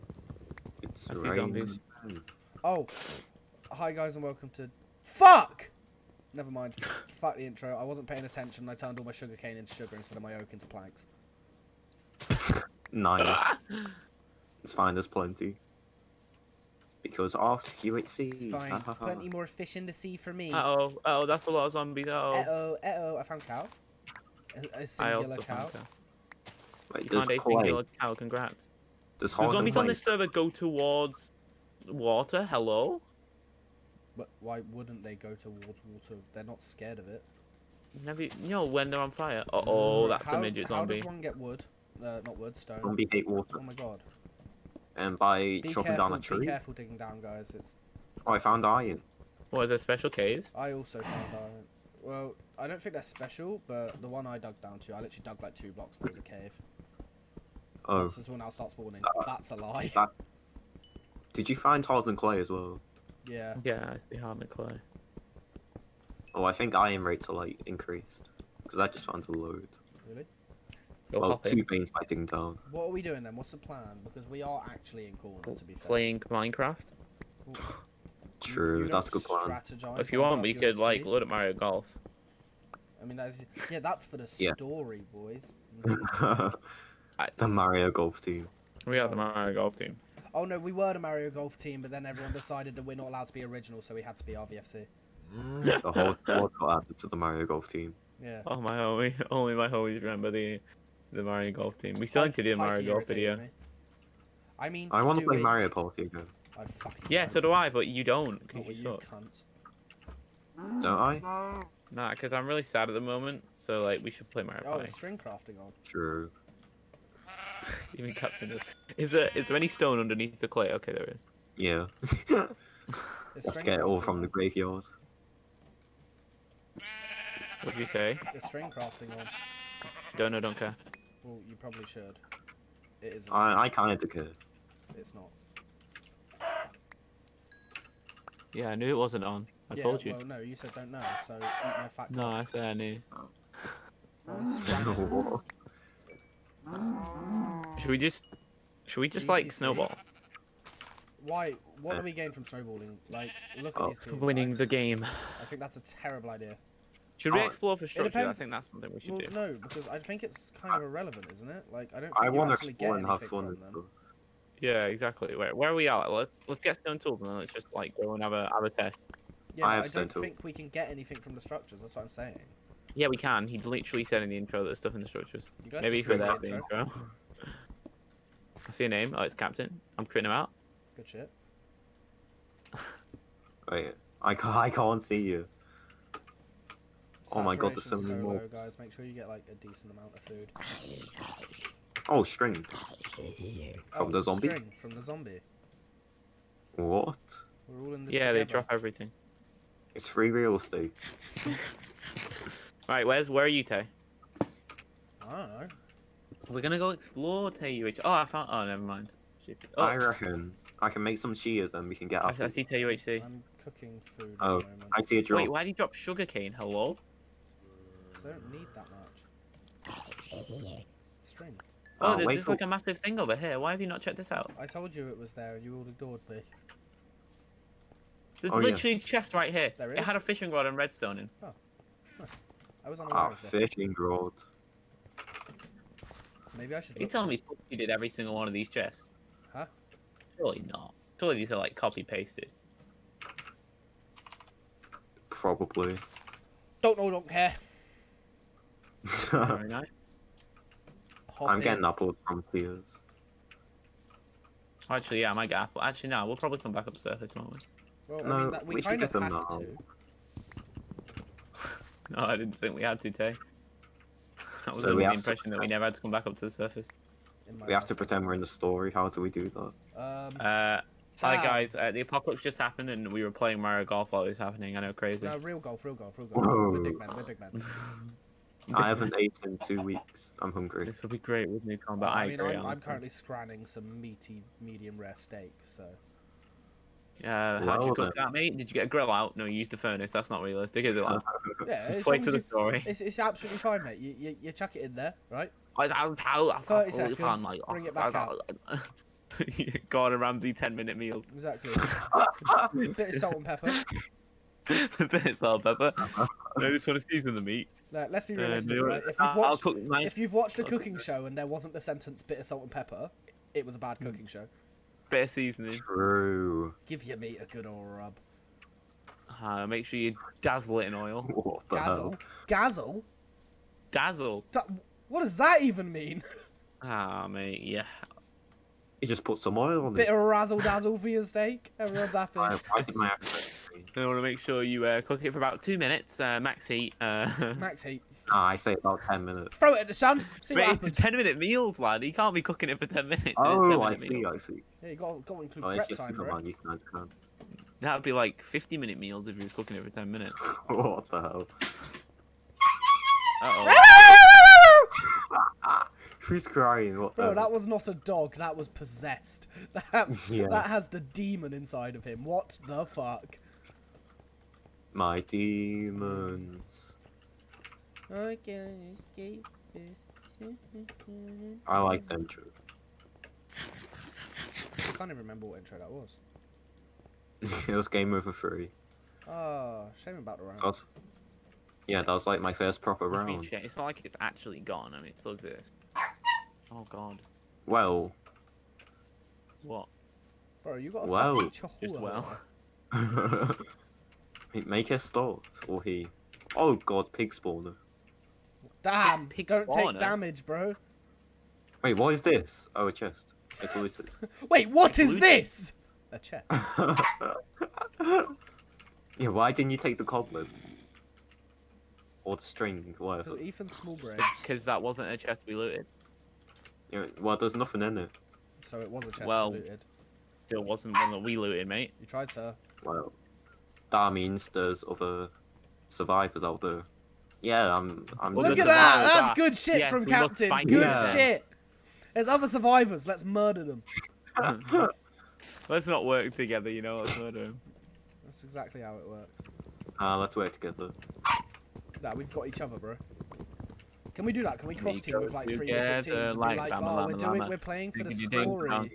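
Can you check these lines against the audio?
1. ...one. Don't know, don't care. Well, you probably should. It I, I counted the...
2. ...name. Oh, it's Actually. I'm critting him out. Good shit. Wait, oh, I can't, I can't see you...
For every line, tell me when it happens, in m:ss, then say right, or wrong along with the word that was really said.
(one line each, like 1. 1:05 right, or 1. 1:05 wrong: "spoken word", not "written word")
1. 2:09 right
2. 2:58 wrong: "Captain", not "Actually".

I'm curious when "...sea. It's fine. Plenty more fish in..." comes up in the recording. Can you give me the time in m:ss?
0:18.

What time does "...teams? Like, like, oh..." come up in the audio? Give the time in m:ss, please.
7:26.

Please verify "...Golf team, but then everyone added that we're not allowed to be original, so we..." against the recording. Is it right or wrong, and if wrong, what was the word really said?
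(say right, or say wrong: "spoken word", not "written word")
wrong: "decided", not "added".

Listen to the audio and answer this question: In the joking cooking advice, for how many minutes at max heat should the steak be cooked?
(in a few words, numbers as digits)
2.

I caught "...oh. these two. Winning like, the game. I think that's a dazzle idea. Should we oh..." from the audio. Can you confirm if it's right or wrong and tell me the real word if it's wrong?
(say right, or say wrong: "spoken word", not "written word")
wrong: "terrible", not "dazzle".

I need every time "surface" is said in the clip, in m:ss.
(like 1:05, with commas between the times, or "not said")
4:16, 4:26.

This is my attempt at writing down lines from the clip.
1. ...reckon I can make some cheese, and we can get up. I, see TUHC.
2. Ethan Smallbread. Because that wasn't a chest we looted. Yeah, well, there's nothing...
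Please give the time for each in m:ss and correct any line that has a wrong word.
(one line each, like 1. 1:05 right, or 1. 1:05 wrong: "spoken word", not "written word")
1. 3:29 right
2. 6:53 right.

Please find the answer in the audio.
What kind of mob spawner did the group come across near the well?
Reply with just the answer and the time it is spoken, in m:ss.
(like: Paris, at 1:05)
Pig spawner, at 6:37.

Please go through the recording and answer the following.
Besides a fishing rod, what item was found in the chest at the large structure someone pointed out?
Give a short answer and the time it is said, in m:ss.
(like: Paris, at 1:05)
Redstone, at 3:50.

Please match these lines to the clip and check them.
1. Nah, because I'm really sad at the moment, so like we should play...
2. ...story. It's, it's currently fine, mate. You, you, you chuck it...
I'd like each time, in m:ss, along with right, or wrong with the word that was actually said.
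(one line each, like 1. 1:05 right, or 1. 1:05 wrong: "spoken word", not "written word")
1. 1:51 right
2. 4:52 wrong: "absolutely", not "currently".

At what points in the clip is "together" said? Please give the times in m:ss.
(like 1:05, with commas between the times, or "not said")
3:18, 7:16, 7:20.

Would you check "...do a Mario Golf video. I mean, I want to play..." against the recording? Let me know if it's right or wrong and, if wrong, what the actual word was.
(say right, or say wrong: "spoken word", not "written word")
right.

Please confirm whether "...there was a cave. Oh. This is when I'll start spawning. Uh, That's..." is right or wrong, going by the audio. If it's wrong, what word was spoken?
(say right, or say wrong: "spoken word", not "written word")
right.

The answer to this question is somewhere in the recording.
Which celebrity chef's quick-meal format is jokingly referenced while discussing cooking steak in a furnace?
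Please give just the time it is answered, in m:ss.
4:59.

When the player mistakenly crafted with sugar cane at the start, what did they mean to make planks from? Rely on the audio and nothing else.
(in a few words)
Oak.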